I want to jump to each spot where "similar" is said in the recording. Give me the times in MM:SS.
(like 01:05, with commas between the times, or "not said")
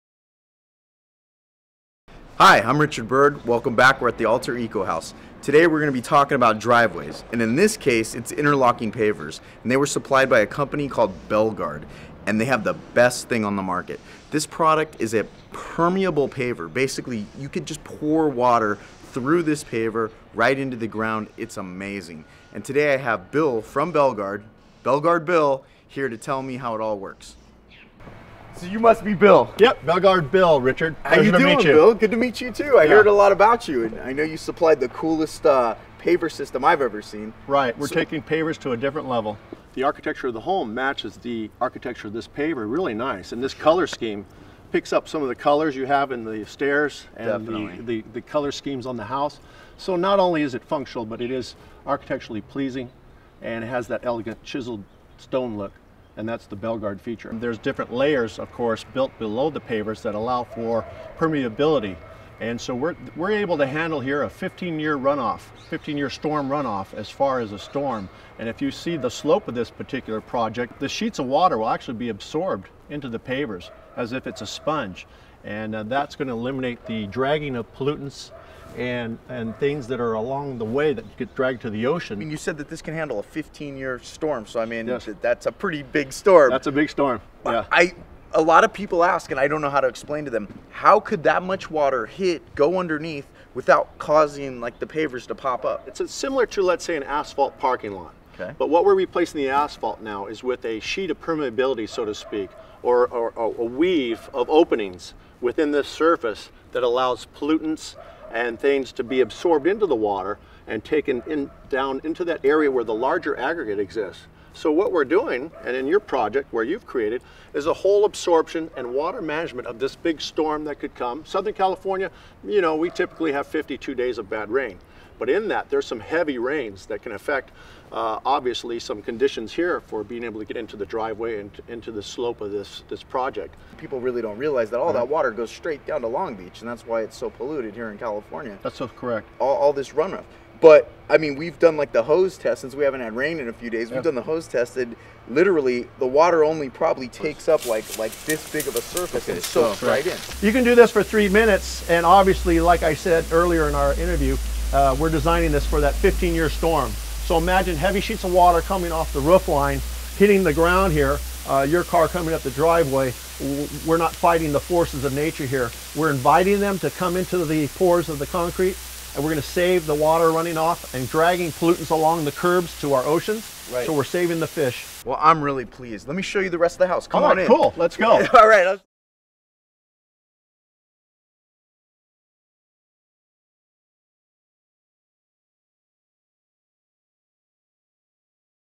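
01:36.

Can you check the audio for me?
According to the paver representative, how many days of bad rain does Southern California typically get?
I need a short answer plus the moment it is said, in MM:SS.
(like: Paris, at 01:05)
52, at 02:03.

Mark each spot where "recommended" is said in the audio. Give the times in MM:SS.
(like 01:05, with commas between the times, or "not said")
not said.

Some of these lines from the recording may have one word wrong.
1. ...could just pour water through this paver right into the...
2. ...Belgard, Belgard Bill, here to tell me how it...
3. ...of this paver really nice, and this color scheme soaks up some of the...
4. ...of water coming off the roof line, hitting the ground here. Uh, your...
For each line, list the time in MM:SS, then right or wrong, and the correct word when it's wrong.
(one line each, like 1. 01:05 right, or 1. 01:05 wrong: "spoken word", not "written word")
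1. 00:17 right
2. 00:23 right
3. 00:42 wrong: "picks", not "soaks"
4. 02:38 right.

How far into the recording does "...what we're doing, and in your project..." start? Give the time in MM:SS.
01:54.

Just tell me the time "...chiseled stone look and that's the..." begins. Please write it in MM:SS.
00:54.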